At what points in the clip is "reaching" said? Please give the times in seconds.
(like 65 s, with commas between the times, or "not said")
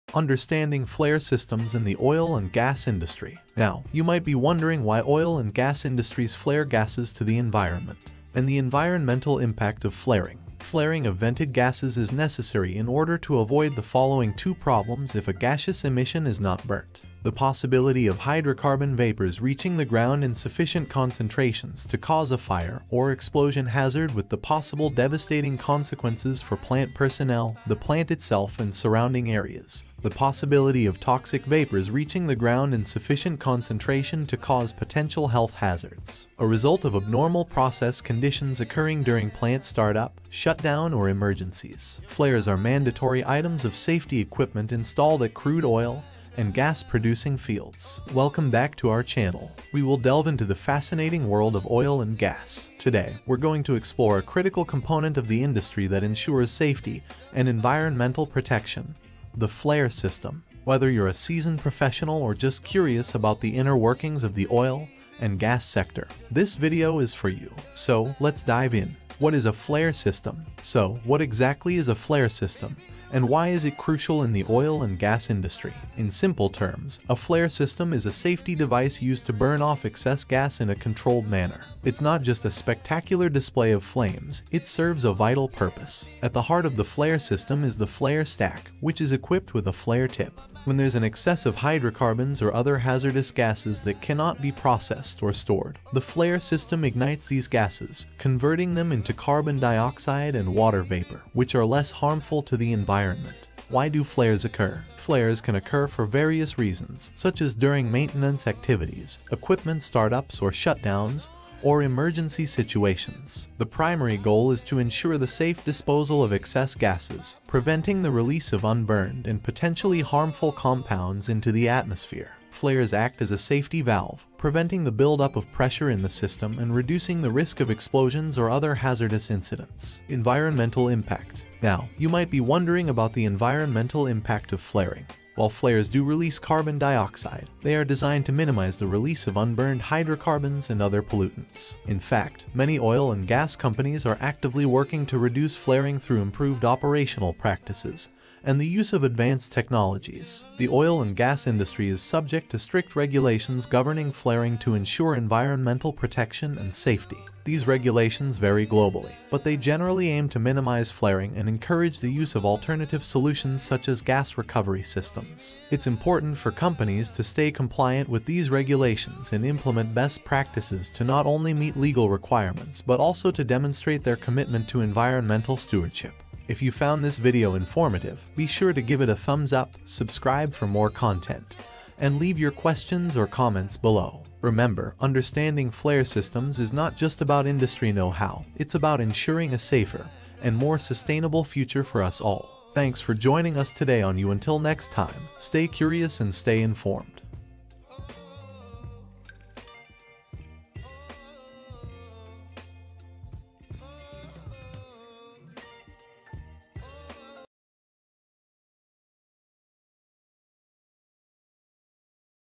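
19 s, 31 s.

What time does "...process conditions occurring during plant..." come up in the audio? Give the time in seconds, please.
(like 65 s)
37 s.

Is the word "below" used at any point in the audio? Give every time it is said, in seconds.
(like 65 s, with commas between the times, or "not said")
183 s.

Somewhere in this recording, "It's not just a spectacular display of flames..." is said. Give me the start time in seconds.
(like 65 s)
81 s.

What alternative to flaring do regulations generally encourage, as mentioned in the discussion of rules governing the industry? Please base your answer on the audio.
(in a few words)
Gas recovery systems.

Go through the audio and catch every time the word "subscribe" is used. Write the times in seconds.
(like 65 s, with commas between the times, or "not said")
179 s.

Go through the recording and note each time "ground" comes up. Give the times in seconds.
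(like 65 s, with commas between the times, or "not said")
19 s, 32 s.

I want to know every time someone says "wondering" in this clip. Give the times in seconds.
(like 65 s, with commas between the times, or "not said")
4 s, 132 s.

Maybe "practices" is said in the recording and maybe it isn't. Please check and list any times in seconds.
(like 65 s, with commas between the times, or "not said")
147 s, 170 s.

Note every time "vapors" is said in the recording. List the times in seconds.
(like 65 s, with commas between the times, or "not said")
18 s, 31 s, 100 s.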